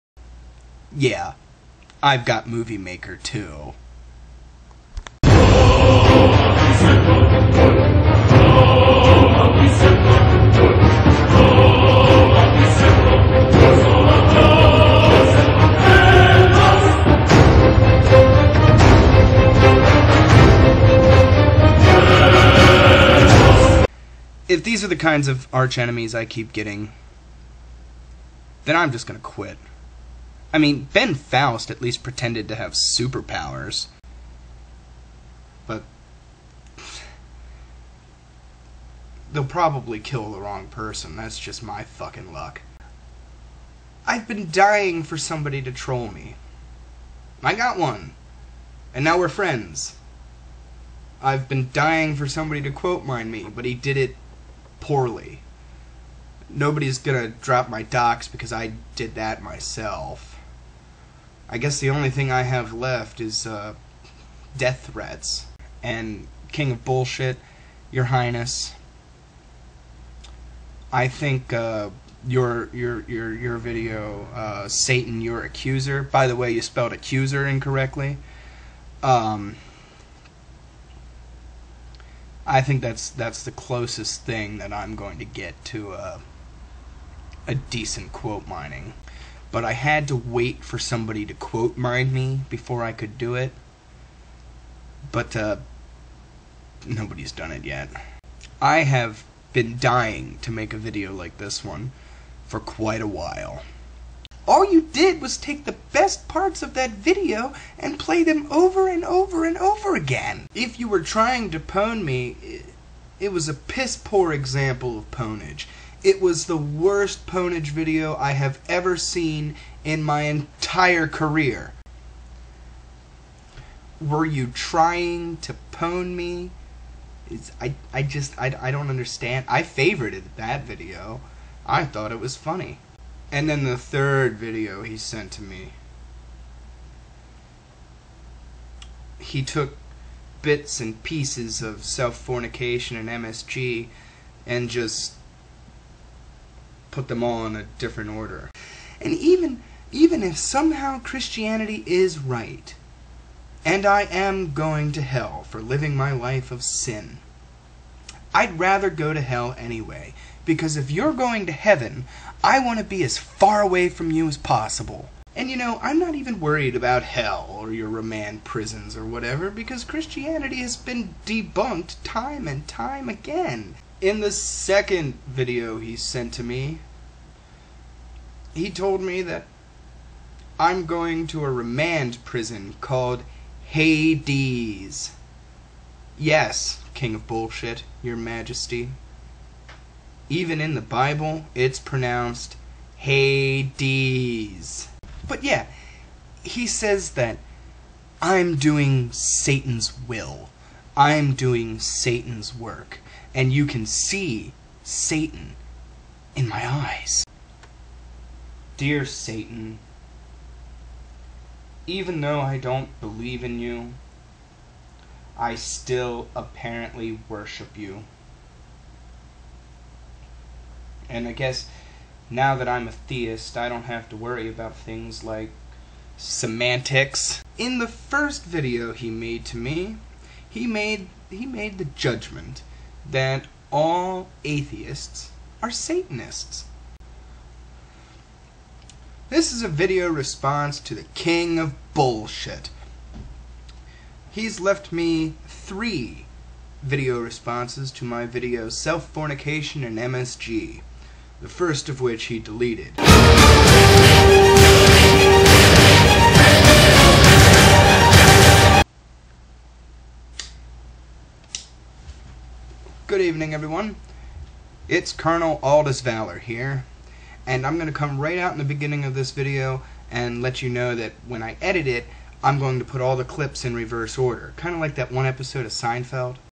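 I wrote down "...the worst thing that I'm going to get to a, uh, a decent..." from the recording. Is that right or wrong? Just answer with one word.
wrong.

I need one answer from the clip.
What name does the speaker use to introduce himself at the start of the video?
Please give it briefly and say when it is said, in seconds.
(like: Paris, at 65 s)
Colonel Aldus Valor, at 265 s.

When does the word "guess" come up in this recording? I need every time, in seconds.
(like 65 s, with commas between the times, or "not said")
61 s, 221 s.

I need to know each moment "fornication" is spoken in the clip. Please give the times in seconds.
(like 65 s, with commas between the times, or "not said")
142 s, 249 s.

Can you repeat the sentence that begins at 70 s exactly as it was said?
I think uh, your your your your video, uh, Satan, your accuser.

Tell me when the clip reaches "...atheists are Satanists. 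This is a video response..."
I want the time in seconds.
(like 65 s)
234 s.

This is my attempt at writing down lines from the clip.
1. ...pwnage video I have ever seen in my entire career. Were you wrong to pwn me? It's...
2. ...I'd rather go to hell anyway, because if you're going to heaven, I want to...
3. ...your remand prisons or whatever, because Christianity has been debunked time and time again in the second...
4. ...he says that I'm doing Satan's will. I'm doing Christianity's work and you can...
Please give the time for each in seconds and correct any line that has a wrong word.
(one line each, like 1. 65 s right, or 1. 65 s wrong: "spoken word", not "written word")
1. 117 s wrong: "trying", not "wrong"
2. 158 s right
3. 167 s right
4. 196 s wrong: "Satan", not "Christianity".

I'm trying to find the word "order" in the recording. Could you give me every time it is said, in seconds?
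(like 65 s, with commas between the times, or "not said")
148 s, 274 s.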